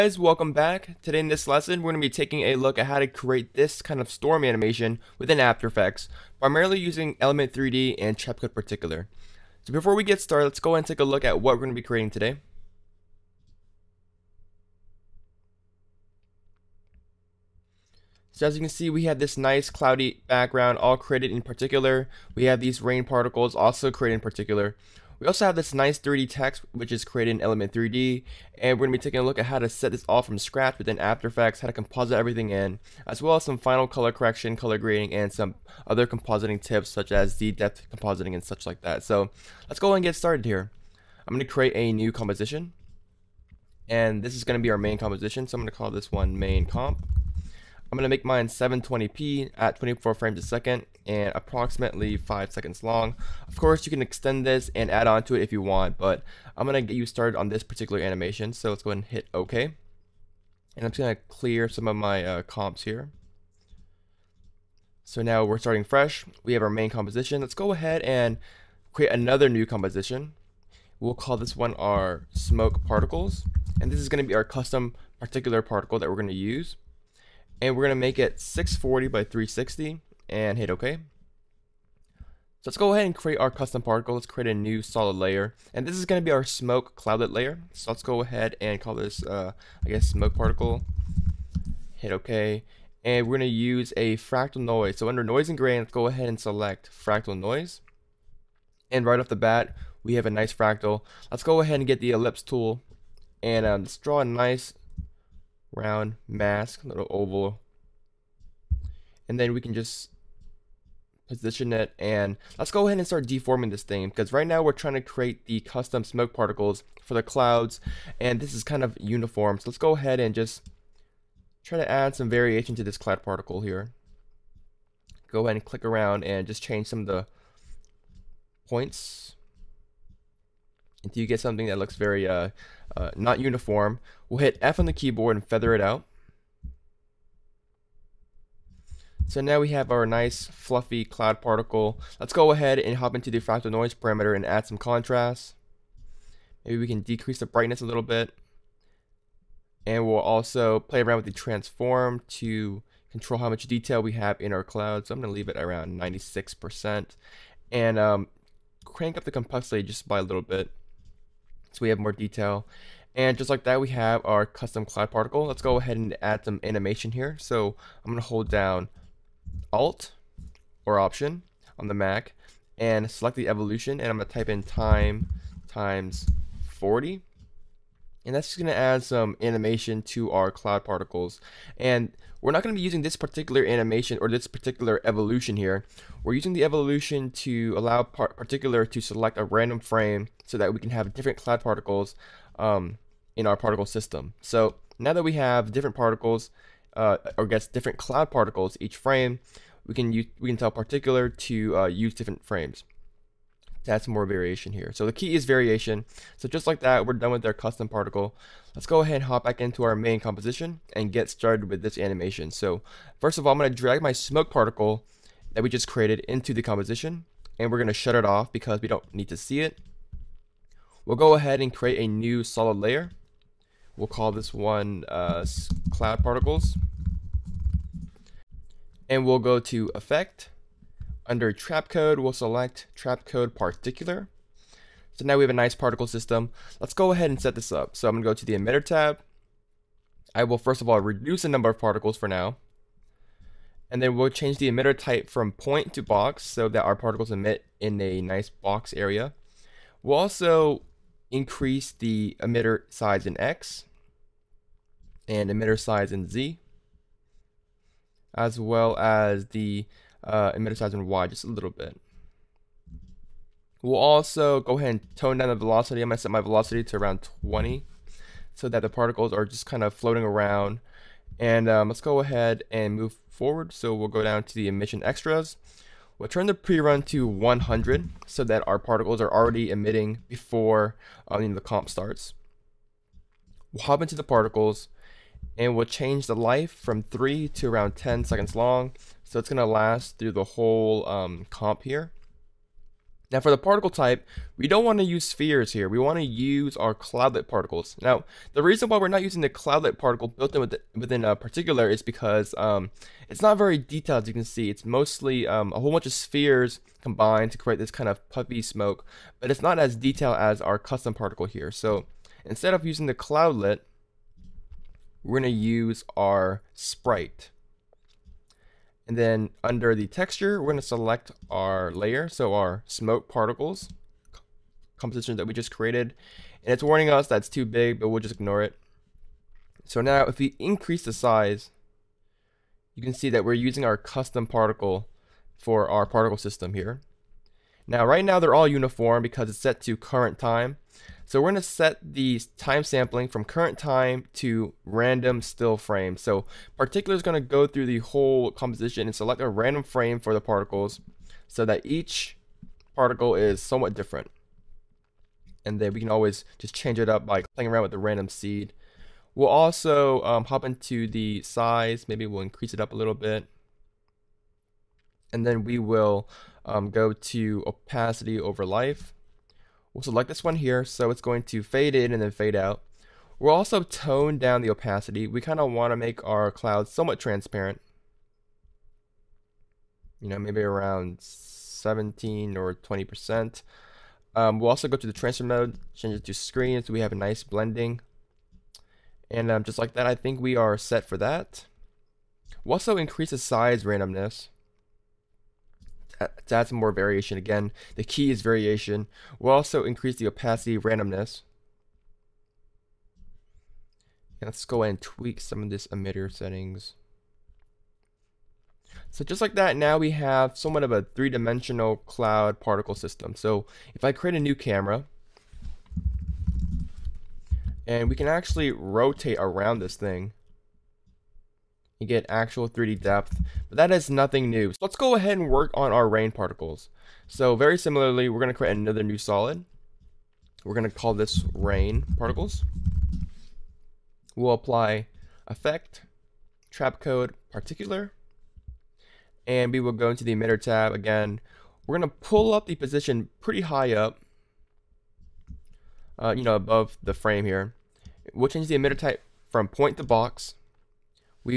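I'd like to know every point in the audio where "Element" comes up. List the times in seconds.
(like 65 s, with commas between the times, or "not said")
7 s, 27 s.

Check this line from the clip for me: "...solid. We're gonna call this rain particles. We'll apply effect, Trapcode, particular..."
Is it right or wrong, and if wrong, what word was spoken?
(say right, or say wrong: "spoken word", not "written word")
right.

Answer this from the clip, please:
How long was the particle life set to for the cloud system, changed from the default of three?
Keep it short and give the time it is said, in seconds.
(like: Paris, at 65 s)
10 seconds, at 287 s.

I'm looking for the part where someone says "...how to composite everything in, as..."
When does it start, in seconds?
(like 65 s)
31 s.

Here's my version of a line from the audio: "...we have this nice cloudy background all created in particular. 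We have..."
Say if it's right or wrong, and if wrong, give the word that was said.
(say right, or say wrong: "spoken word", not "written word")
right.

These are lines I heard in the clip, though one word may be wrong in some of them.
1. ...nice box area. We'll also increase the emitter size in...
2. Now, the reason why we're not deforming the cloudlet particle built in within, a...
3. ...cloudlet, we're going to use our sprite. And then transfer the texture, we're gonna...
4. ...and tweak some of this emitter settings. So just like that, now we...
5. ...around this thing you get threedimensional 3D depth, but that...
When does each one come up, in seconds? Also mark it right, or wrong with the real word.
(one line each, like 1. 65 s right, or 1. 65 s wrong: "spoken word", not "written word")
1. 248 s right
2. 298 s wrong: "using", not "deforming"
3. 313 s wrong: "under", not "transfer"
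4. 404 s right
5. 419 s wrong: "actual", not "threedimensional".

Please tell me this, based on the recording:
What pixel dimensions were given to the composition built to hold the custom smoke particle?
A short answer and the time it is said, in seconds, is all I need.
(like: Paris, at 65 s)
640 by 360, at 78 s.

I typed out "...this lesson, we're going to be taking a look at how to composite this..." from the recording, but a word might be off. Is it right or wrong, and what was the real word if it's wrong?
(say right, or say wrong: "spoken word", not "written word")
wrong: "create", not "composite".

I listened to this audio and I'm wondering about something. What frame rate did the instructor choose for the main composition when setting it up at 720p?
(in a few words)
24 frames a second.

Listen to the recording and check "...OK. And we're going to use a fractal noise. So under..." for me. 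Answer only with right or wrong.
right.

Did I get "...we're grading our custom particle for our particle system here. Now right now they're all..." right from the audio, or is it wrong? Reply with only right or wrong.
wrong.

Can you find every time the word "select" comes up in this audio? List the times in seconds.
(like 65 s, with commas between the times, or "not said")
96 s, 173 s, 189 s, 232 s, 320 s, 349 s, 370 s.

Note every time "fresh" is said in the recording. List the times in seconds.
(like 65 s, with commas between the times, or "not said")
65 s.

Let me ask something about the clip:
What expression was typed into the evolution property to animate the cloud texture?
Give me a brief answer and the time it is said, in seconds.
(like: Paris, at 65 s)
time times 40, at 174 s.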